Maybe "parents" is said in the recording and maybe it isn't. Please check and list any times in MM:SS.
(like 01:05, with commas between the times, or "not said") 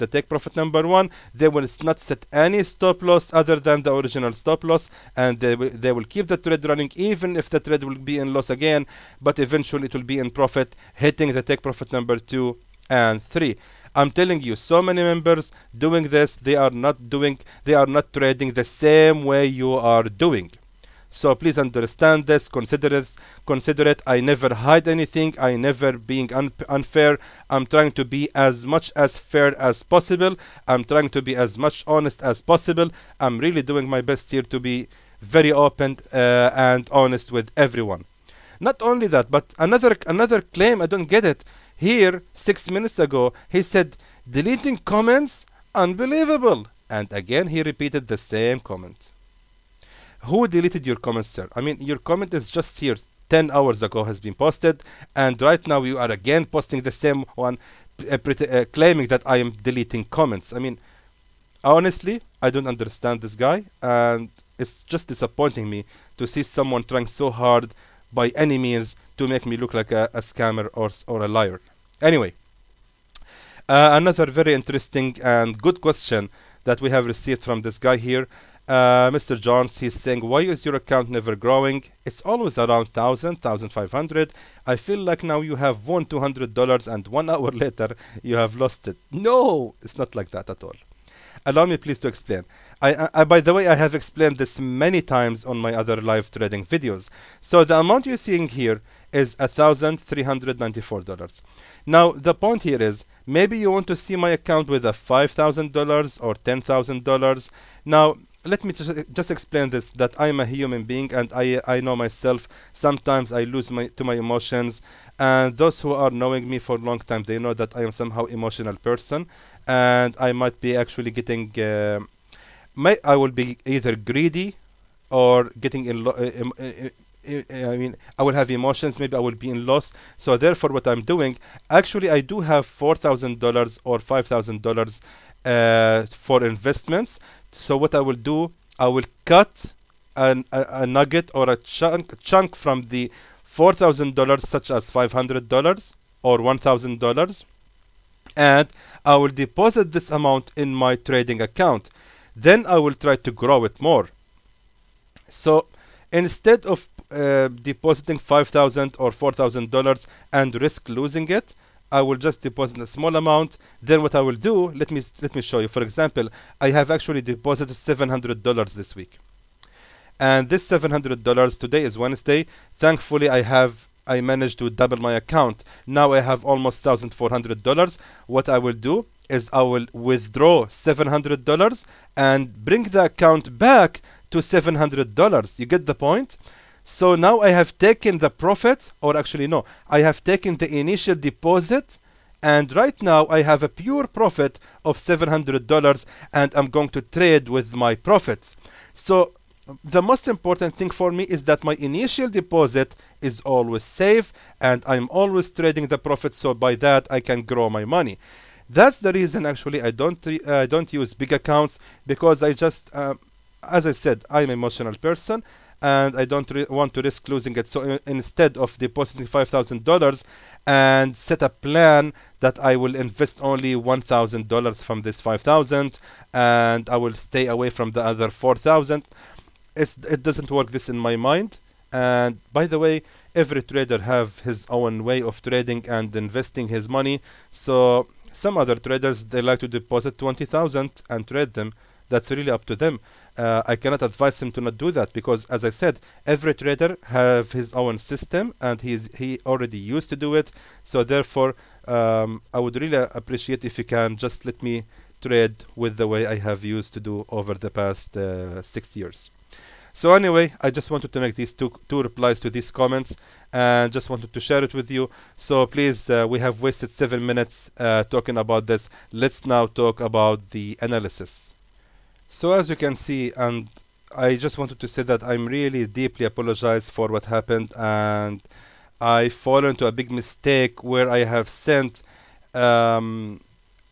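not said.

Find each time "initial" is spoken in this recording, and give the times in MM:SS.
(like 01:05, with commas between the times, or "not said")
03:10, 03:21.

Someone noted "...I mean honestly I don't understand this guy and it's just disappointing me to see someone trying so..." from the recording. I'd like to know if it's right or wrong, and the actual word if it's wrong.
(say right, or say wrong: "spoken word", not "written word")
right.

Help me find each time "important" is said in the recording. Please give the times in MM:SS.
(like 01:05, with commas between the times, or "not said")
03:20.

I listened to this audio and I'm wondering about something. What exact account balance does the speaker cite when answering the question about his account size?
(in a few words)
$1,394.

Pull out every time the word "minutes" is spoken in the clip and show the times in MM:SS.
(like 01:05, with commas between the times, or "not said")
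00:42, 04:27.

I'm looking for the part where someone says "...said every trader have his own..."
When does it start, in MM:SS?
04:05.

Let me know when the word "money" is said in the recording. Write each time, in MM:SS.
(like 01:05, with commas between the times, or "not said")
03:27, 03:56.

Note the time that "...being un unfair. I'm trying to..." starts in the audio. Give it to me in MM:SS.
00:26.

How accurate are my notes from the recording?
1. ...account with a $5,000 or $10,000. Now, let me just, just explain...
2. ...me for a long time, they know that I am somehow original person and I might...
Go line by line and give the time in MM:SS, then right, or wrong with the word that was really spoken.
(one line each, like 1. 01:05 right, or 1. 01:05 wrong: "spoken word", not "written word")
1. 01:44 right
2. 01:56 wrong: "emotional", not "original".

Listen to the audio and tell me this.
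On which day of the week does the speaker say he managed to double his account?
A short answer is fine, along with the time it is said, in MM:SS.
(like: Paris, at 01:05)
Wednesday, at 02:51.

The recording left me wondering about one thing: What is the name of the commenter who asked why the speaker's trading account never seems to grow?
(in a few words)
Mr. Johns.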